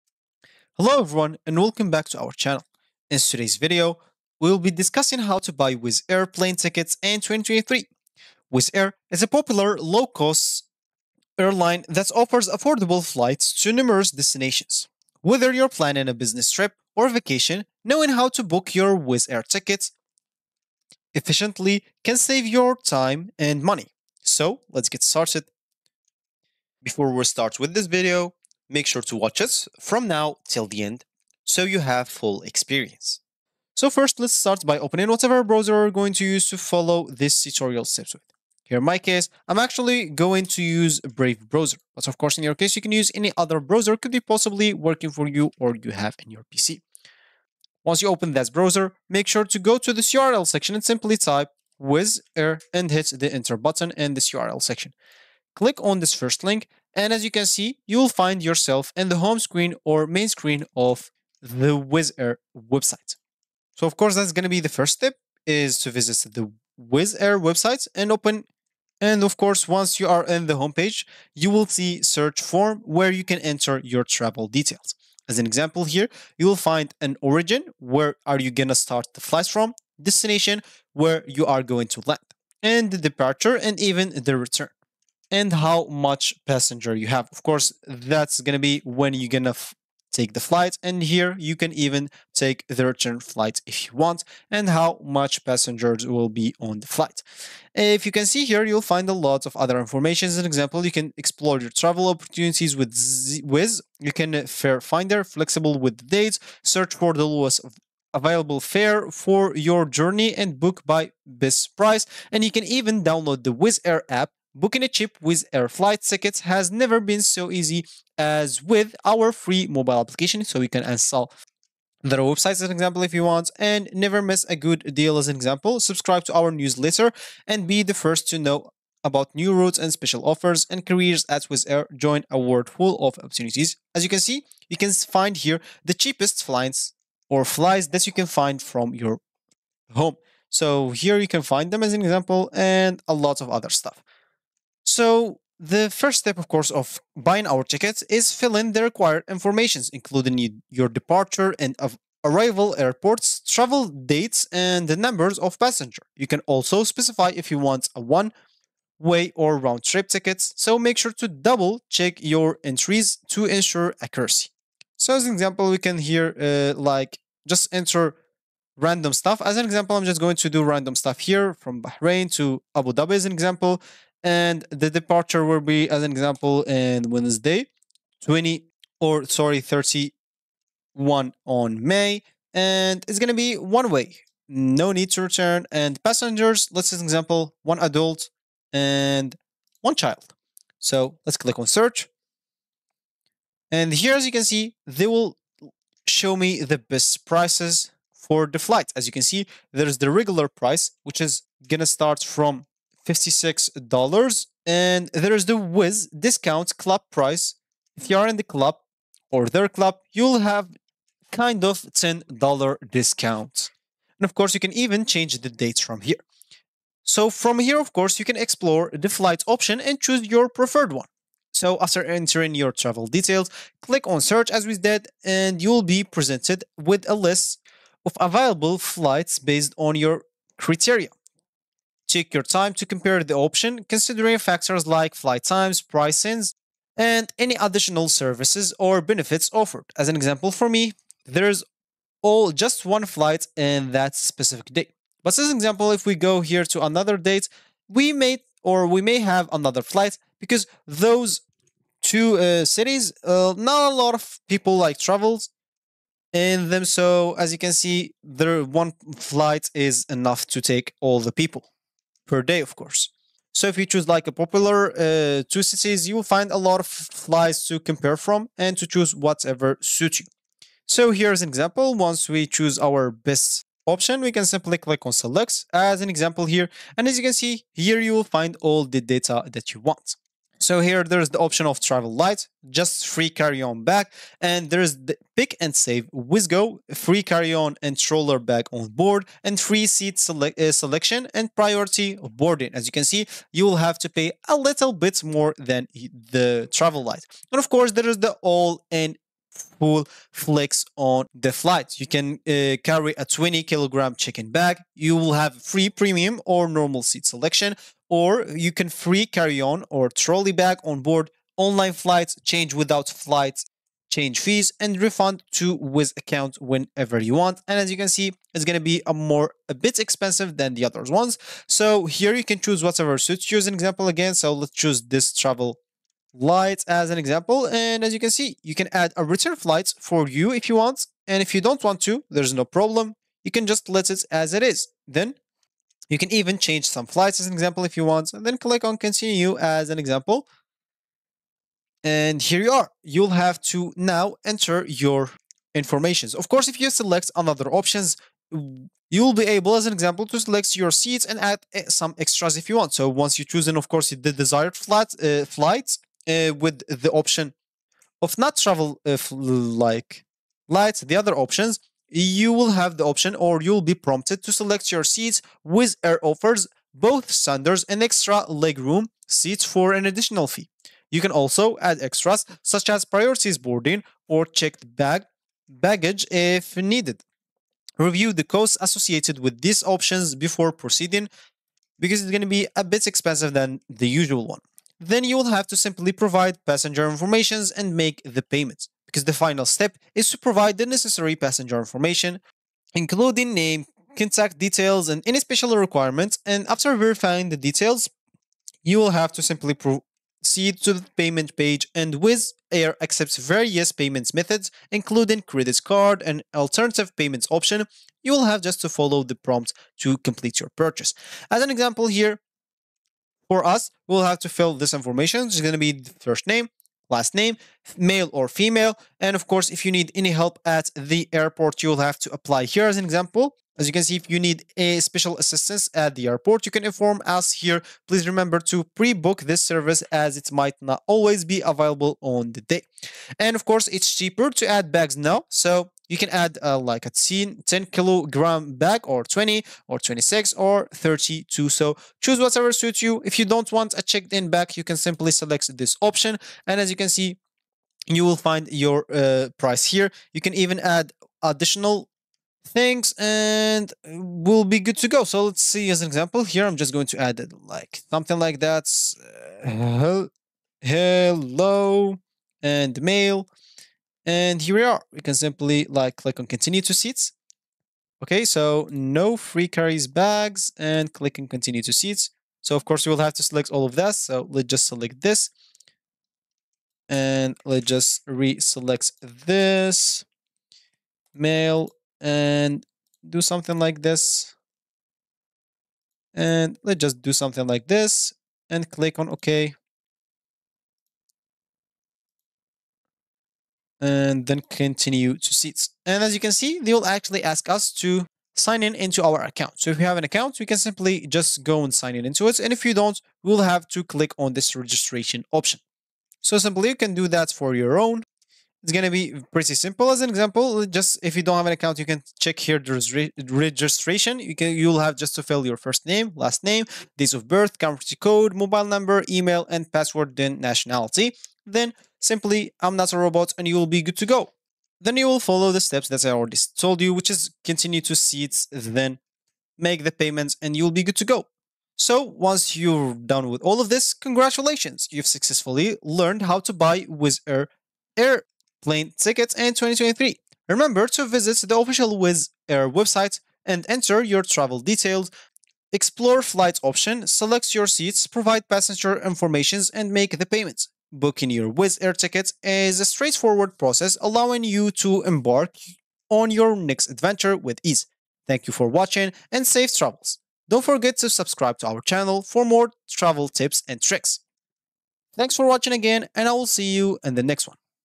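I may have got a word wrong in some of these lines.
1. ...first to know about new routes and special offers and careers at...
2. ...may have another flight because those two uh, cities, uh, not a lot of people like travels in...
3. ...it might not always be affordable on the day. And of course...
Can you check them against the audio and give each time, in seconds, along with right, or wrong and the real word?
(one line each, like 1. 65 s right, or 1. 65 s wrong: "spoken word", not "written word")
1. 127 s right
2. 249 s right
3. 430 s wrong: "available", not "affordable".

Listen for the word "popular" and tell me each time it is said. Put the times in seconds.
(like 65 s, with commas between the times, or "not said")
9 s, 264 s.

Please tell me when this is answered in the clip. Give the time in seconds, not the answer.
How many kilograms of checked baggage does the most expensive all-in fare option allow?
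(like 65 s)
303 s.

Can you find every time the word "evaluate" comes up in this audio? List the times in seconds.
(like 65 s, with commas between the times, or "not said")
not said.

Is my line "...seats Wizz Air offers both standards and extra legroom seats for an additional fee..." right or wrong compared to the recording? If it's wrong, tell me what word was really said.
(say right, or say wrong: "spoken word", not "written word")
right.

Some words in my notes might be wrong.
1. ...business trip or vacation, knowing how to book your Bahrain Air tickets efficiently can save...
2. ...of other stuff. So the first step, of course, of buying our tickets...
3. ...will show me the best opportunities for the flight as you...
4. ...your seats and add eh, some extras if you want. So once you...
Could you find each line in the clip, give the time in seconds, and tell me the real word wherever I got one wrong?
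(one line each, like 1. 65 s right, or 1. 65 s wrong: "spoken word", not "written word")
1. 16 s wrong: "Wizz", not "Bahrain"
2. 143 s right
3. 195 s wrong: "prices", not "opportunities"
4. 350 s right.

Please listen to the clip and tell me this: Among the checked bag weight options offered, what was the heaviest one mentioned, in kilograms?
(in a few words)
32.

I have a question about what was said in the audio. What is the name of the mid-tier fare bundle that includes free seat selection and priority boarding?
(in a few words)
Wizz Go.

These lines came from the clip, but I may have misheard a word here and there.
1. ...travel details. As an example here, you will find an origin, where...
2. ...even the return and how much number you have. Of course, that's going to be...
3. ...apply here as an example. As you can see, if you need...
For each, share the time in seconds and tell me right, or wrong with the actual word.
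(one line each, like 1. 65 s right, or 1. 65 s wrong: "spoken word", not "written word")
1. 74 s right
2. 83 s wrong: "passenger", not "number"
3. 422 s right.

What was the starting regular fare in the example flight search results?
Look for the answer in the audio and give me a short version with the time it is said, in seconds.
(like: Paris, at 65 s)
$56, at 203 s.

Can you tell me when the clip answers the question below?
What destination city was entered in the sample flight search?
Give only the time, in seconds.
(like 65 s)
172 s.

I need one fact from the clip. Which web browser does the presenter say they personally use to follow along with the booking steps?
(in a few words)
Brave.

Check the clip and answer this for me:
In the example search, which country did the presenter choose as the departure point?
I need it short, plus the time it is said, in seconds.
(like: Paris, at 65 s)
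Bahrain, at 171 s.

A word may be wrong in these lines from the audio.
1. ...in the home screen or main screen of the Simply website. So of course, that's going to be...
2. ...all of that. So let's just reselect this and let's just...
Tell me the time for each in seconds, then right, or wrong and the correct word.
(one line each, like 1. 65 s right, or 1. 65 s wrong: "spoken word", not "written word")
1. 58 s wrong: "Wizz", not "Simply"
2. 473 s wrong: "select", not "reselect".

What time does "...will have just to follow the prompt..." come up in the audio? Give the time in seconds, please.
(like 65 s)
408 s.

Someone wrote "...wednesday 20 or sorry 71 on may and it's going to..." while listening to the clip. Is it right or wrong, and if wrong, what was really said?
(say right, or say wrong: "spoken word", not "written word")
wrong: "31", not "71".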